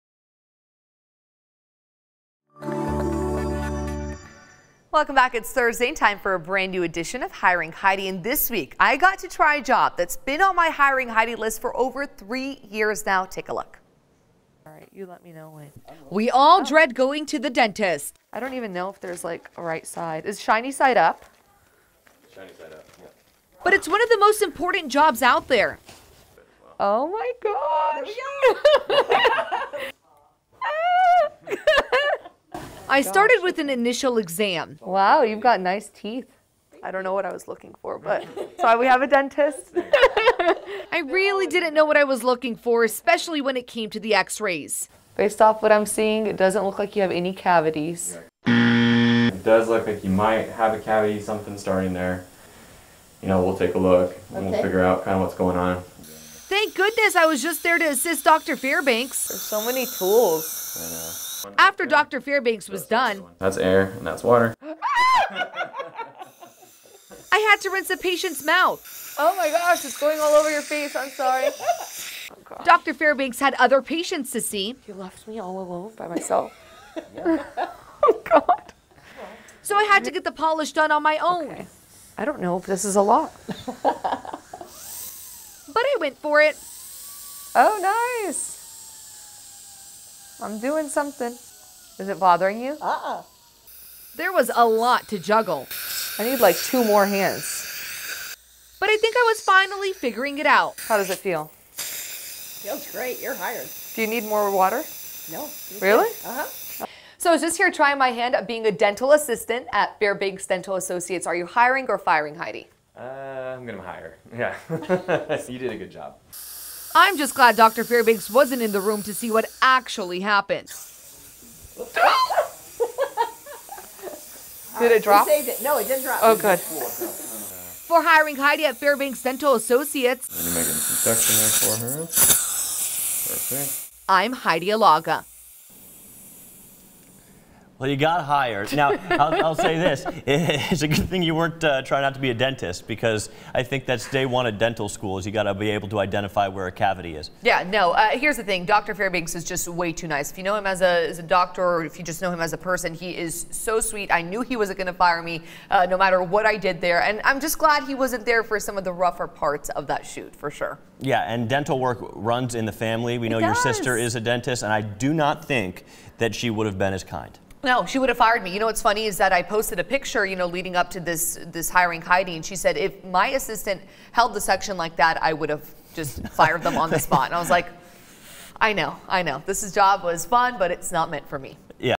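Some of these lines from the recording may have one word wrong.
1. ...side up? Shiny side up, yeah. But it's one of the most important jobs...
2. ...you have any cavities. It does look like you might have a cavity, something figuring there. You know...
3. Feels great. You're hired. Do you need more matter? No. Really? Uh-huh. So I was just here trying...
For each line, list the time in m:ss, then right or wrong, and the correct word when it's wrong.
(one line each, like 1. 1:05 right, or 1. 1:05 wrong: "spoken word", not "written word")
1. 0:20 right
2. 0:46 wrong: "starting", not "figuring"
3. 1:41 wrong: "water", not "matter".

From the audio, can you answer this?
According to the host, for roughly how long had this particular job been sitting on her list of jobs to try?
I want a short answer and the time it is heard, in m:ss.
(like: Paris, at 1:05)
Over 3 years, at 0:11.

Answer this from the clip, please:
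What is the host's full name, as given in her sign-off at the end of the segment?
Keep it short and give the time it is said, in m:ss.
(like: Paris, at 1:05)
Heidi Alaga, at 2:14.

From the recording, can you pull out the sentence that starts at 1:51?
Are you hiring or firing, Heidi?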